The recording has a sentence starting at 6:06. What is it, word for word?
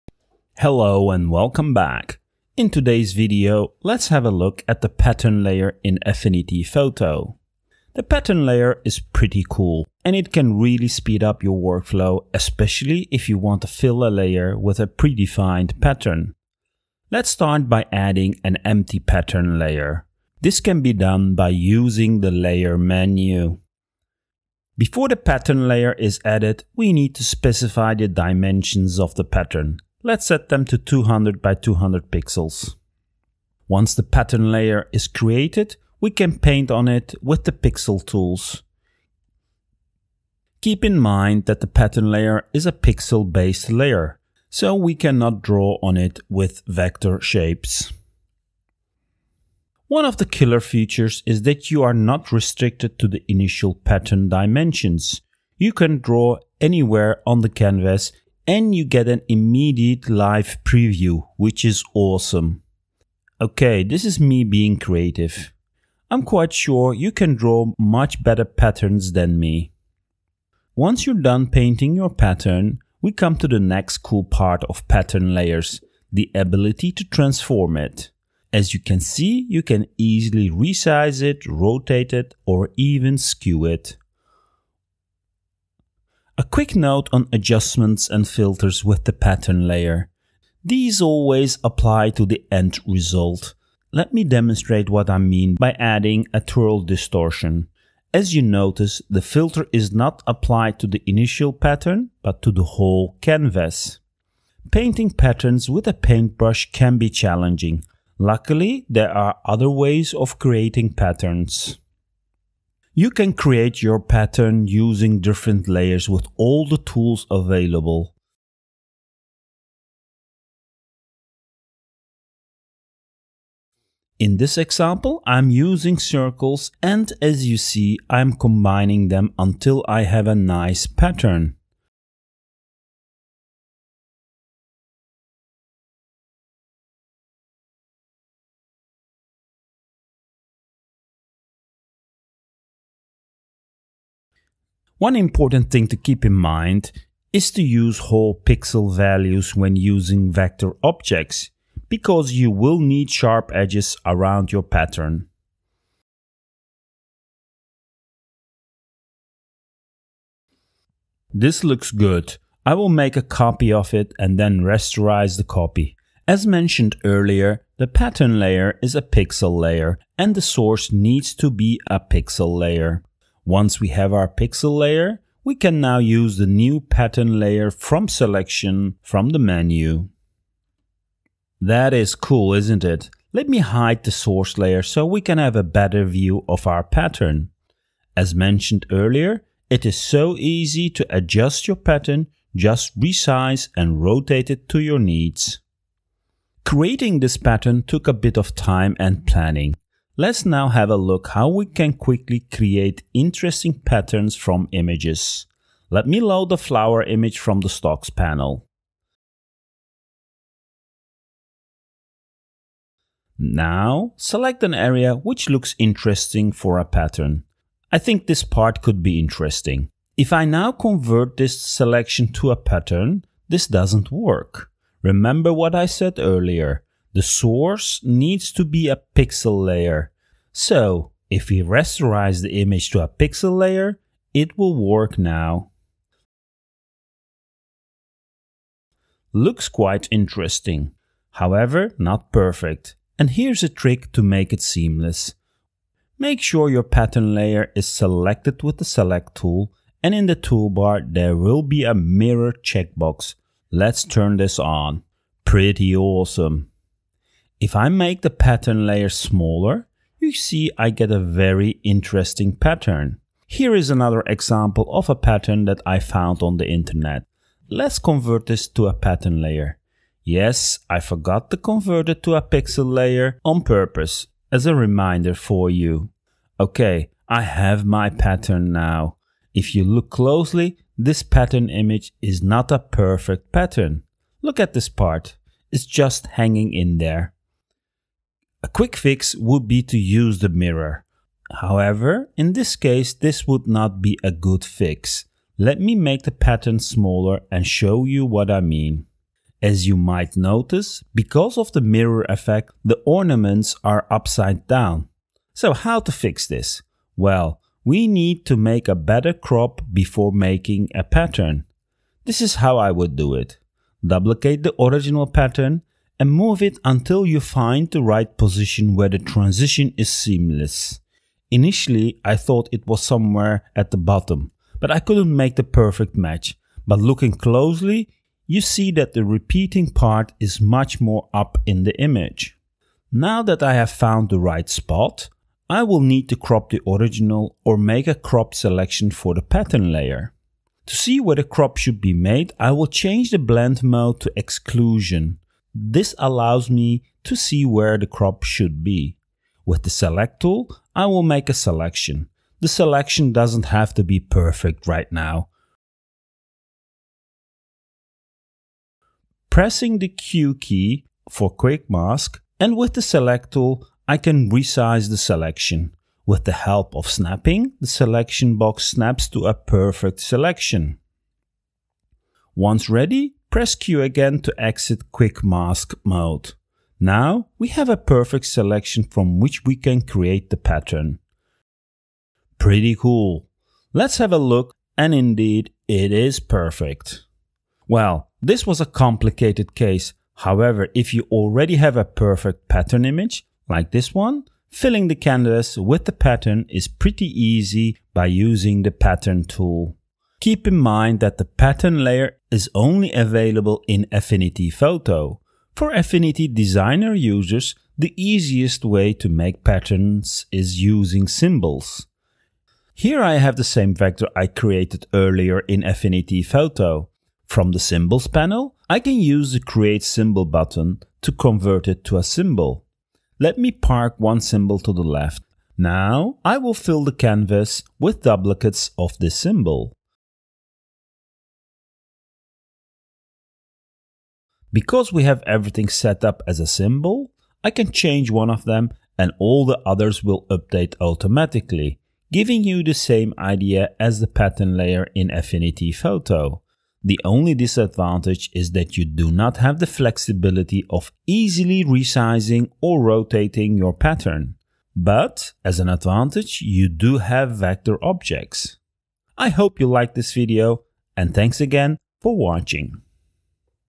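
With the help of snapping, the selection box snaps to a perfect selection.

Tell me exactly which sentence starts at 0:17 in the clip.
Let's start by adding an empty pattern layer.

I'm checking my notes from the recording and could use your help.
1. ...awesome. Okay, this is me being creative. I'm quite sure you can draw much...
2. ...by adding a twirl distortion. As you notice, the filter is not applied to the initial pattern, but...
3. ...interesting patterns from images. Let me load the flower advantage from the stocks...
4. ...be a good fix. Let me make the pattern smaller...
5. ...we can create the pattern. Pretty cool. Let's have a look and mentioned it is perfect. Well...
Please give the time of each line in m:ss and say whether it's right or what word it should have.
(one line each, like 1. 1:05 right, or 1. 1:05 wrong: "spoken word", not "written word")
1. 1:01 right
2. 1:35 right
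3. 3:23 wrong: "image", not "advantage"
4. 4:54 right
5. 6:19 wrong: "indeed", not "mentioned".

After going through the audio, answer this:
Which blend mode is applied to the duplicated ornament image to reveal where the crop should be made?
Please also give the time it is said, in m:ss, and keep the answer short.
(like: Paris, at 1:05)
exclusion, at 5:44.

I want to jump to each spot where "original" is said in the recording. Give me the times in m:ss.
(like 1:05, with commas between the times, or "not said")
5:14, 5:36.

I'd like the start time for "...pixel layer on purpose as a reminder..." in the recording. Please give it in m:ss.
4:32.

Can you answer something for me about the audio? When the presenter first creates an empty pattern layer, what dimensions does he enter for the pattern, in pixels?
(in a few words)
200 by 200 pixels.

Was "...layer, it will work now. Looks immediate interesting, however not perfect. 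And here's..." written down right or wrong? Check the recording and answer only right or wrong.
wrong.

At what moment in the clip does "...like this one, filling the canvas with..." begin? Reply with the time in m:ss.
6:33.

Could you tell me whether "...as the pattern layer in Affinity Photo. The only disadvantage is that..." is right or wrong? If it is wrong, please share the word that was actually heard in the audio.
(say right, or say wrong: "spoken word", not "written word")
right.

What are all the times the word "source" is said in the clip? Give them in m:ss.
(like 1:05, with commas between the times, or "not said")
2:50, 3:04, 3:47.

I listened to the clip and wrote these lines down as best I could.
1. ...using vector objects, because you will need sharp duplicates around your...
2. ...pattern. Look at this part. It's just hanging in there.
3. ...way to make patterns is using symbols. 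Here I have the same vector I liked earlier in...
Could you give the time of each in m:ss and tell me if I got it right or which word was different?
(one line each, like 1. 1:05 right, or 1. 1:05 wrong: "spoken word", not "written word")
1. 2:29 wrong: "edges", not "duplicates"
2. 4:43 right
3. 6:48 wrong: "created", not "liked".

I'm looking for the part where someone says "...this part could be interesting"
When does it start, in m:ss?
3:38.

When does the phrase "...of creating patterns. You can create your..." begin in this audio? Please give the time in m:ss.
1:50.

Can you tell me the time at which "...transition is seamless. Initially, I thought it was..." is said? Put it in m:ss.
5:19.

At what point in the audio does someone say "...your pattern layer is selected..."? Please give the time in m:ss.
4:06.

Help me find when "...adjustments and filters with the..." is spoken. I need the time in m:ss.
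1:27.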